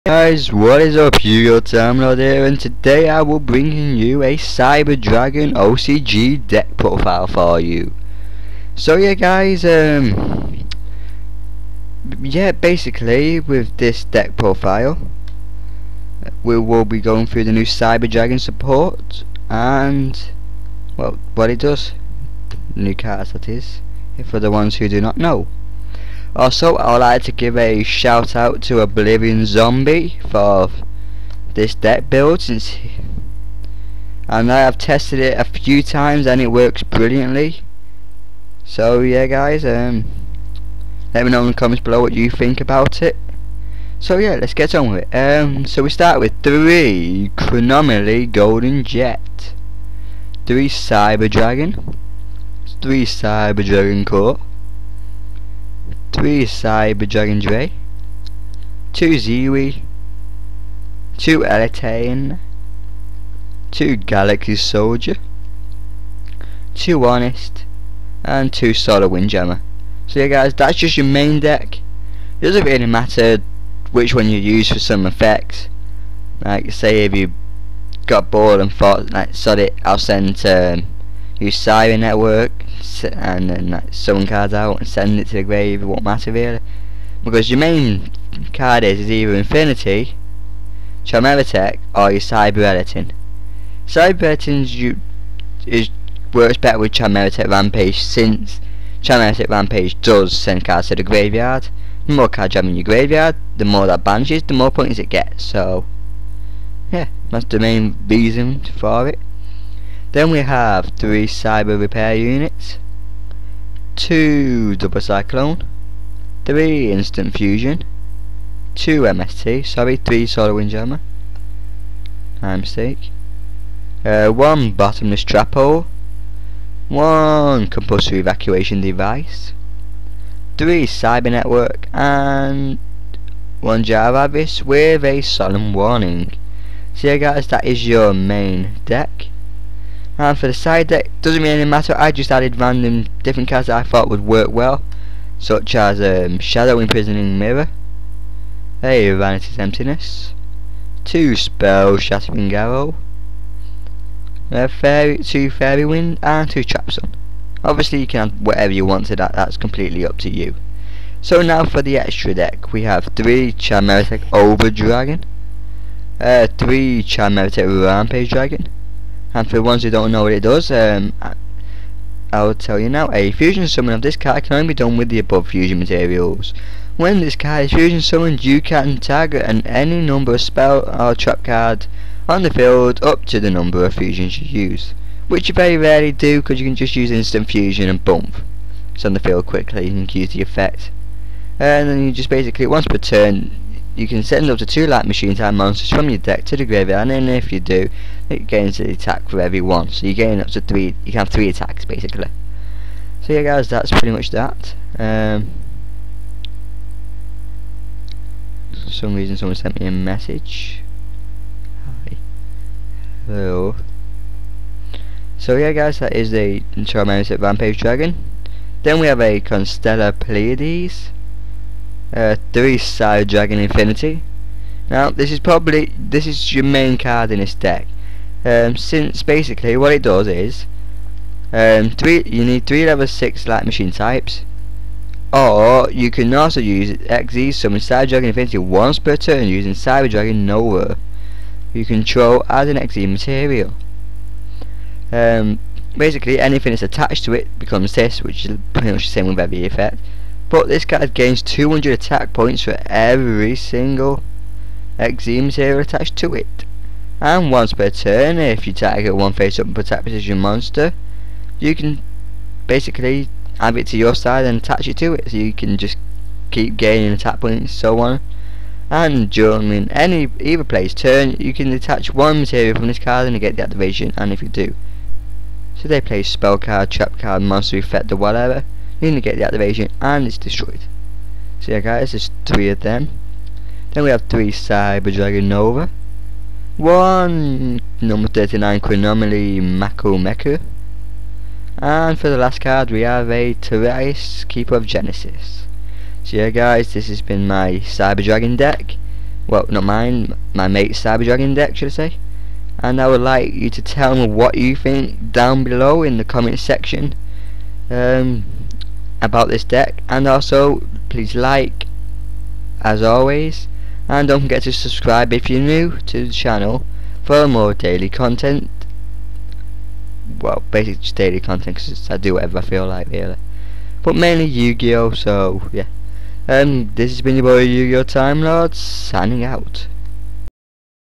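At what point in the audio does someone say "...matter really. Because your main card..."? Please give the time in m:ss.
1:26.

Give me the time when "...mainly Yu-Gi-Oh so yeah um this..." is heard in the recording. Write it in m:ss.
5:24.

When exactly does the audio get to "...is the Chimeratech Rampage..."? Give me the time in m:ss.
3:36.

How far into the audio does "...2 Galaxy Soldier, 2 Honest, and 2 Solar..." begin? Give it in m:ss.
1:03.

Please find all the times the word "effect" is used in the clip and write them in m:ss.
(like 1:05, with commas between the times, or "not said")
1:15, 3:10, 4:09, 4:37.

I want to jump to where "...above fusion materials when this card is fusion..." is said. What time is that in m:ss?
2:55.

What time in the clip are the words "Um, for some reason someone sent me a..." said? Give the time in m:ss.
3:24.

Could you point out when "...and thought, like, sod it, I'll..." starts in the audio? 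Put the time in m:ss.
1:18.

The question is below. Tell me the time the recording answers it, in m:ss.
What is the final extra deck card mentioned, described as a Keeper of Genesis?
4:53.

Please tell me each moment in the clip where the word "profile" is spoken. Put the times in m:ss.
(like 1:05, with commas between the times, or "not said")
0:06, 0:14.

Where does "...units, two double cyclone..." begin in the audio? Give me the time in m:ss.
1:52.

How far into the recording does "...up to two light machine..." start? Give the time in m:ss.
3:14.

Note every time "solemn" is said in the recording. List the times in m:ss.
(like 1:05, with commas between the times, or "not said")
2:15.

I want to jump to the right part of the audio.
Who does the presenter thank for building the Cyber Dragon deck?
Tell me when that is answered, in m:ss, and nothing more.
0:28.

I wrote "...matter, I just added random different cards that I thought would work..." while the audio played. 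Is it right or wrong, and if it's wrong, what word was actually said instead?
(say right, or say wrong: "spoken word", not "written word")
right.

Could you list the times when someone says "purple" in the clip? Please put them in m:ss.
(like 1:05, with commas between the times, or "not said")
not said.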